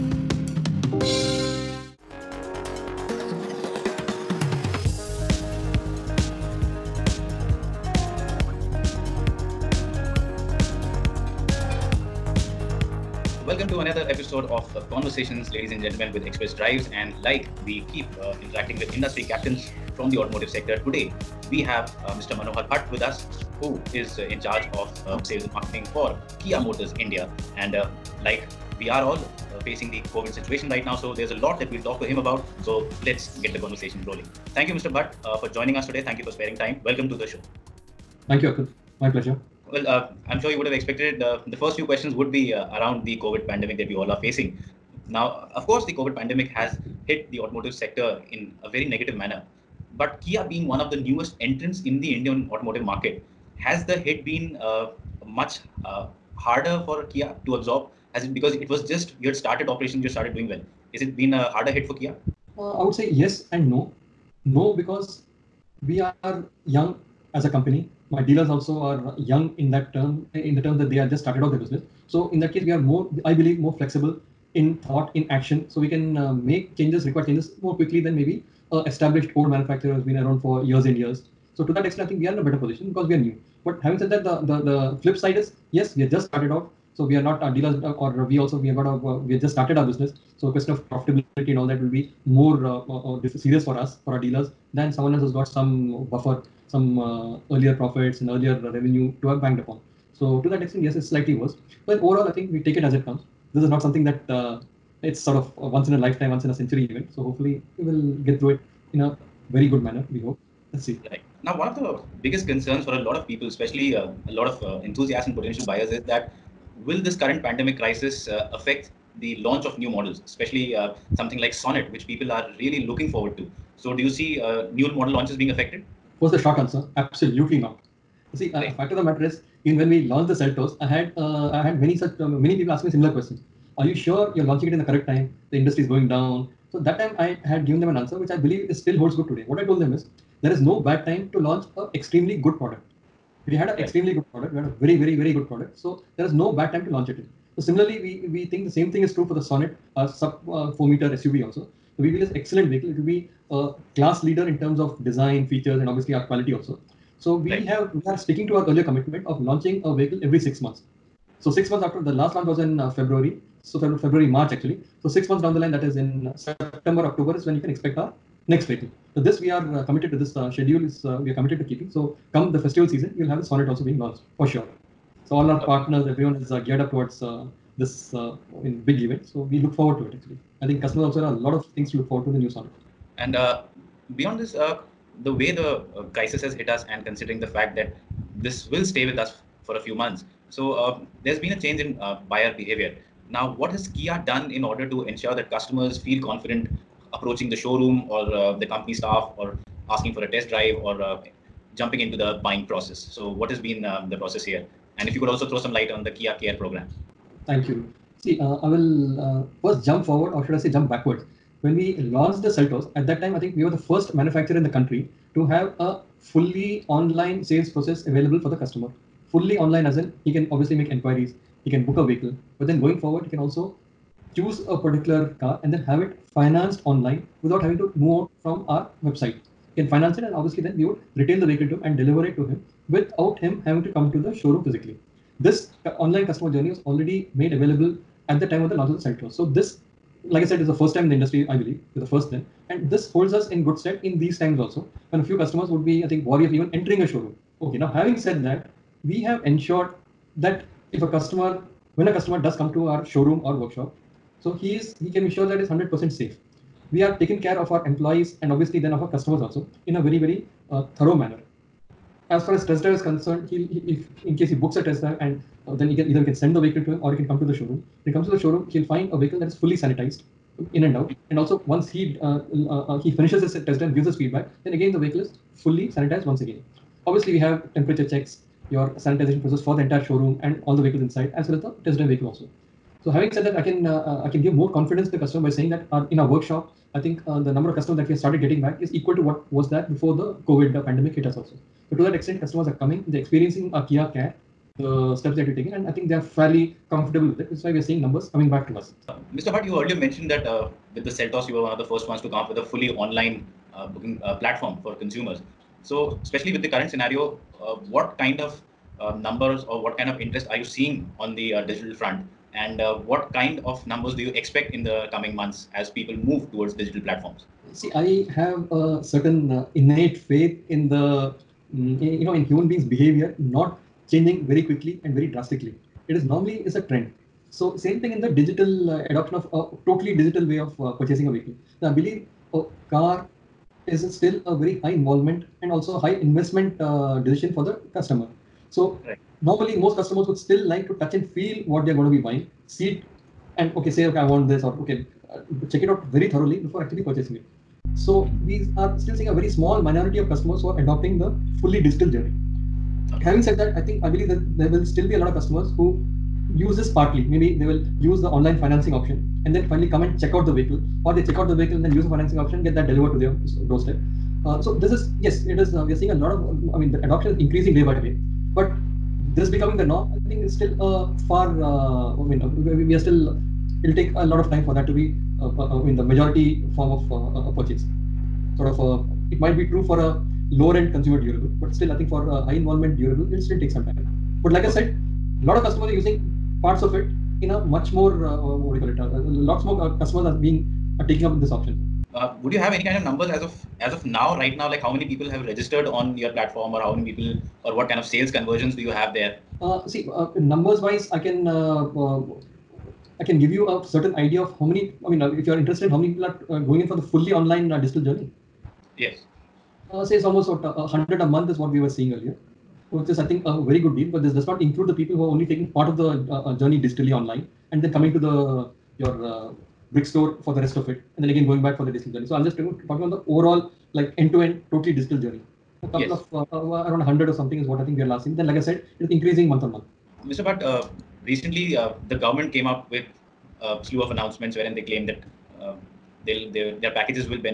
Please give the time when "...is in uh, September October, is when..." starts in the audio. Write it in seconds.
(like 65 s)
165 s.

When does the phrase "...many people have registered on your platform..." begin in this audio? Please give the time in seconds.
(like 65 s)
394 s.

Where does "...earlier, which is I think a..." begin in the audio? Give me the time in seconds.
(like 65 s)
412 s.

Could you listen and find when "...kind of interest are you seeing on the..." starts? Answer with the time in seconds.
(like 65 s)
309 s.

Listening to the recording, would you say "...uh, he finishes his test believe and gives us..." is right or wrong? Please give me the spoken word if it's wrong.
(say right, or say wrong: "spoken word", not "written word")
wrong: "drive", not "believe".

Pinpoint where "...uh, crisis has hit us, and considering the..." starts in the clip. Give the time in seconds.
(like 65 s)
185 s.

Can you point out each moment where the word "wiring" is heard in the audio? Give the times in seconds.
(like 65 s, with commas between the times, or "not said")
not said.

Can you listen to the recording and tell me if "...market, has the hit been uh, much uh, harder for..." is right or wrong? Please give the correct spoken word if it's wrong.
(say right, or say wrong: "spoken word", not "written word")
right.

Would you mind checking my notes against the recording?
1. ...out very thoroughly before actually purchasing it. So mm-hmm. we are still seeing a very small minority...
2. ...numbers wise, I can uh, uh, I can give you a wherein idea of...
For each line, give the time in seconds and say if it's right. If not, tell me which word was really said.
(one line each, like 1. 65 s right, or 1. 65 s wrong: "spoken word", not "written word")
1. 345 s right
2. 400 s wrong: "certain", not "wherein".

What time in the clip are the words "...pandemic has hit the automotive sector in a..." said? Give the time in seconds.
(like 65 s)
46 s.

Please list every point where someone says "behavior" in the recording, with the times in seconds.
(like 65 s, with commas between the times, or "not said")
192 s, 322 s.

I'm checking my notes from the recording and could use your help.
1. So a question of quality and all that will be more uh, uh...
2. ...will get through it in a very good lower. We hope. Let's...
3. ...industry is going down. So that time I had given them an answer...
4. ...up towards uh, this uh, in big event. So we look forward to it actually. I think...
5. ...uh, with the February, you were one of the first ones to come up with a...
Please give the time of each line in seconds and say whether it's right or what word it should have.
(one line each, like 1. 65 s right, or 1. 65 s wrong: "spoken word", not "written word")
1. 90 s wrong: "profitability", not "quality"
2. 107 s wrong: "manner", not "lower"
3. 135 s right
4. 176 s right
5. 300 s wrong: "Seltos", not "February".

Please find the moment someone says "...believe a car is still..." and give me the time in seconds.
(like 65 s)
331 s.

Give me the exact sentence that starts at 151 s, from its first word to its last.
So we feel it's excellent vehicle.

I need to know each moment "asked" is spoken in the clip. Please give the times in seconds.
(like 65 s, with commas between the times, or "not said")
not said.